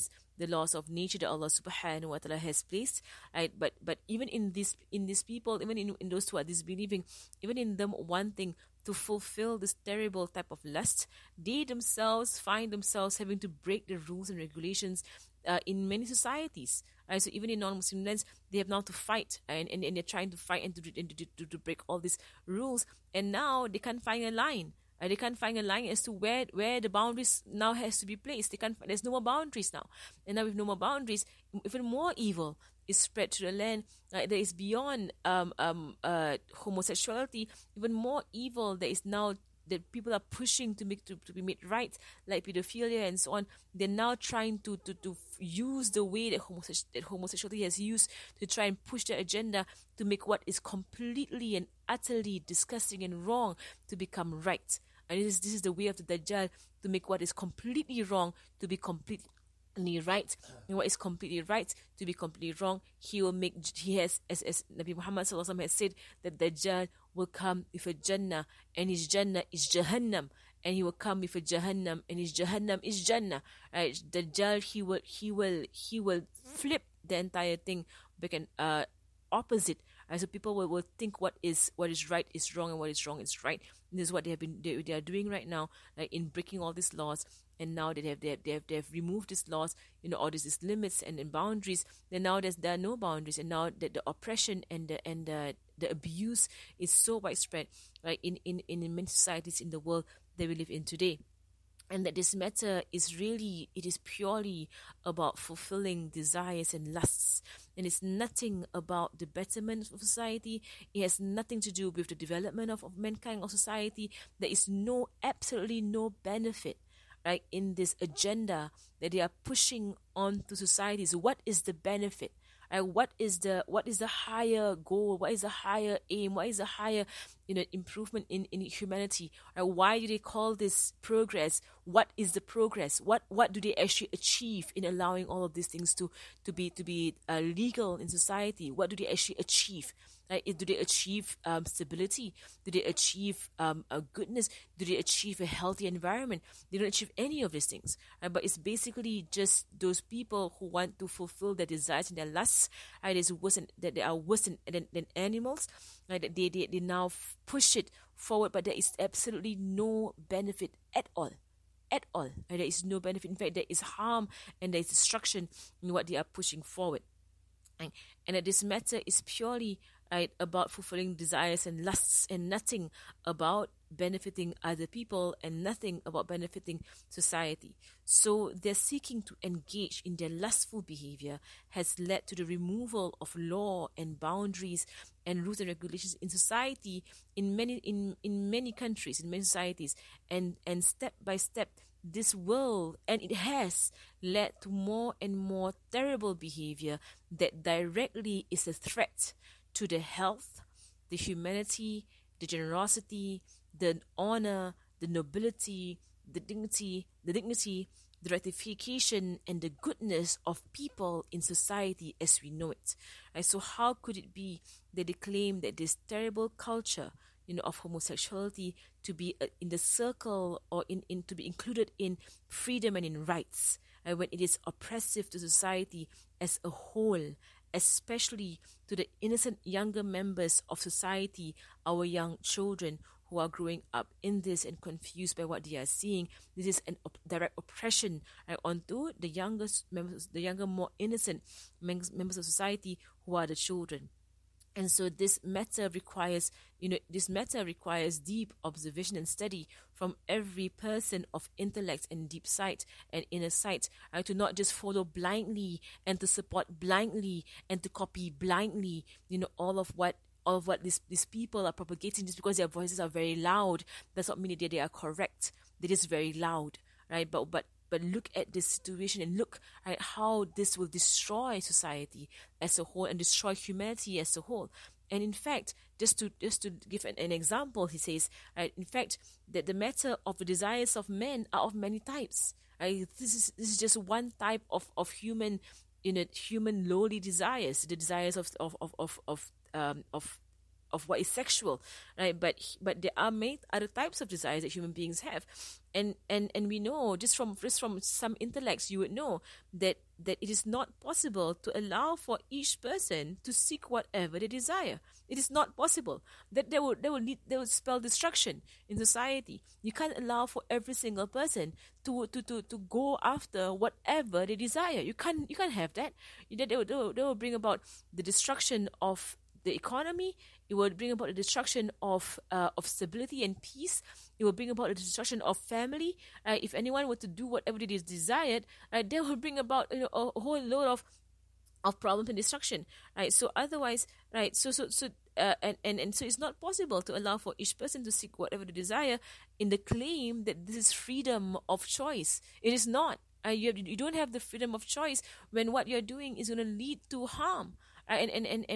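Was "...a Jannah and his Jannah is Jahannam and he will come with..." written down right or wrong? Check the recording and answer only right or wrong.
right.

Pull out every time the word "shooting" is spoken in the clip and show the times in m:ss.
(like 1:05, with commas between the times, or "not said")
not said.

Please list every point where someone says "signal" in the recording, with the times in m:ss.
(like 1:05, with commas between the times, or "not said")
not said.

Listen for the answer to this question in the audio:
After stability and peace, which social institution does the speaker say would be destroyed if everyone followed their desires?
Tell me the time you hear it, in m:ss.
5:25.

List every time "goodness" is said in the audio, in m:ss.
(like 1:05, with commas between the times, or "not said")
2:24, 3:29.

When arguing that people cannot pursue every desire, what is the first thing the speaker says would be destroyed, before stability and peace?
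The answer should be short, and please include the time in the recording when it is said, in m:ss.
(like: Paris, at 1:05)
The economy, at 5:19.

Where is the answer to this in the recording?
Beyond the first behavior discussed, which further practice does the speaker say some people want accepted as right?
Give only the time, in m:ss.
0:42.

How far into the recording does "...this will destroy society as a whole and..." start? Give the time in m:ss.
4:30.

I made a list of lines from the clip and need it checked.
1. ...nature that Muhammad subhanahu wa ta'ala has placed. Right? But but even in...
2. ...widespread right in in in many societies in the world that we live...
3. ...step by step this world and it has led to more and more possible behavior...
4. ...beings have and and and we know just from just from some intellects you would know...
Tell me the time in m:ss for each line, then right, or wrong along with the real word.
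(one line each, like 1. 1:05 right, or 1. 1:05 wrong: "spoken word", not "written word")
1. 0:00 wrong: "Allah", not "Muhammad"
2. 1:37 right
3. 3:10 wrong: "terrible", not "possible"
4. 4:54 right.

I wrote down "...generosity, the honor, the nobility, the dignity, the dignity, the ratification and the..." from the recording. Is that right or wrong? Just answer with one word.
right.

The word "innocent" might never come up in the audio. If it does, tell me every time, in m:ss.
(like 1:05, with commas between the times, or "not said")
3:49, 4:00.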